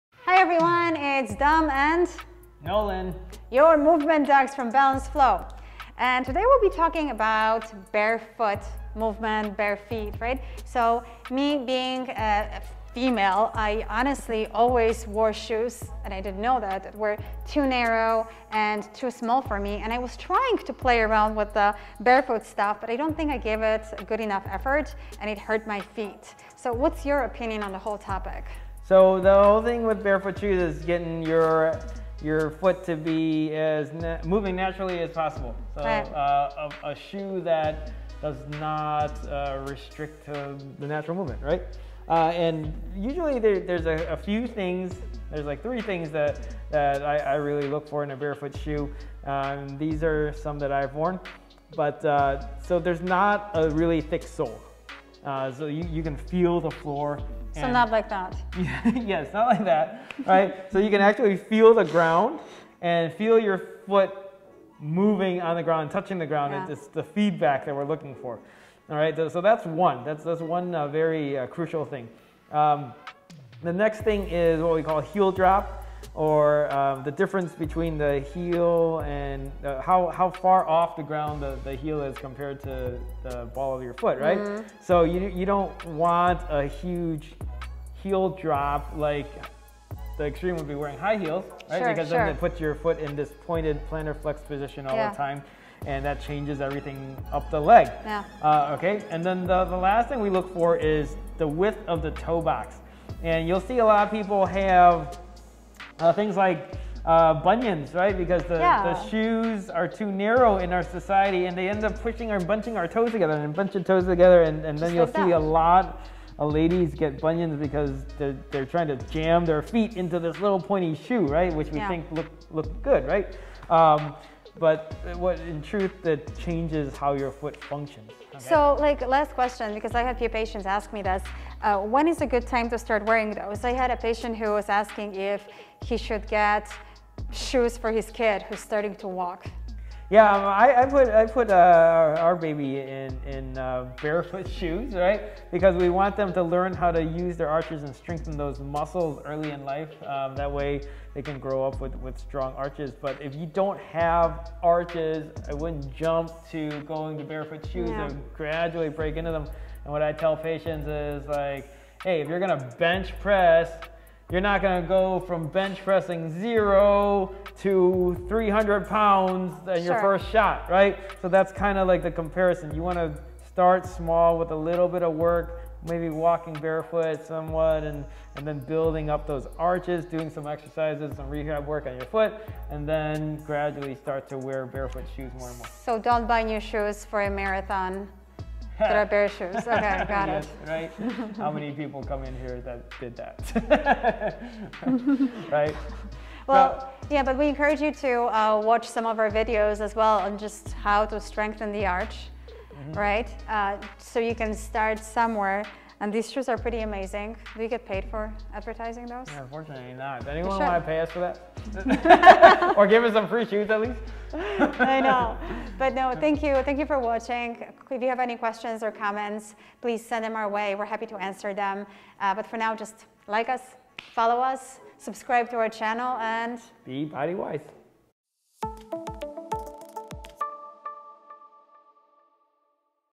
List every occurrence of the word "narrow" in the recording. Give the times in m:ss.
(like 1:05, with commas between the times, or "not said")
0:17, 1:50.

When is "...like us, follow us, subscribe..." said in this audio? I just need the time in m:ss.
3:43.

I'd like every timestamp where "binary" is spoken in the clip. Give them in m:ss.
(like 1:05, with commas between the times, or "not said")
not said.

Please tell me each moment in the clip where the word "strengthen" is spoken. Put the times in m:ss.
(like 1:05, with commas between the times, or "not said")
2:27, 3:21.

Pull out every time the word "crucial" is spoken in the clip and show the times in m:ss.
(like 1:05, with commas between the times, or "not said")
1:11.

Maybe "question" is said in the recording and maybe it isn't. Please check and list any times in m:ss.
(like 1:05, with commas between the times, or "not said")
2:09, 3:38.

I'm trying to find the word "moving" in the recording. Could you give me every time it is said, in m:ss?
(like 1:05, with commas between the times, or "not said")
0:34, 1:04.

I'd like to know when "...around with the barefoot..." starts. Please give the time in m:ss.
0:21.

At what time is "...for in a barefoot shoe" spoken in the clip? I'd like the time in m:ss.
0:47.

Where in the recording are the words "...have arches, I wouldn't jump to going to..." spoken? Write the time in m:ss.
2:33.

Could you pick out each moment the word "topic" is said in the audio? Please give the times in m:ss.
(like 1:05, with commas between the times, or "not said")
0:27.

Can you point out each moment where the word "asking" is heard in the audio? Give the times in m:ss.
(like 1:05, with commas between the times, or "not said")
2:14.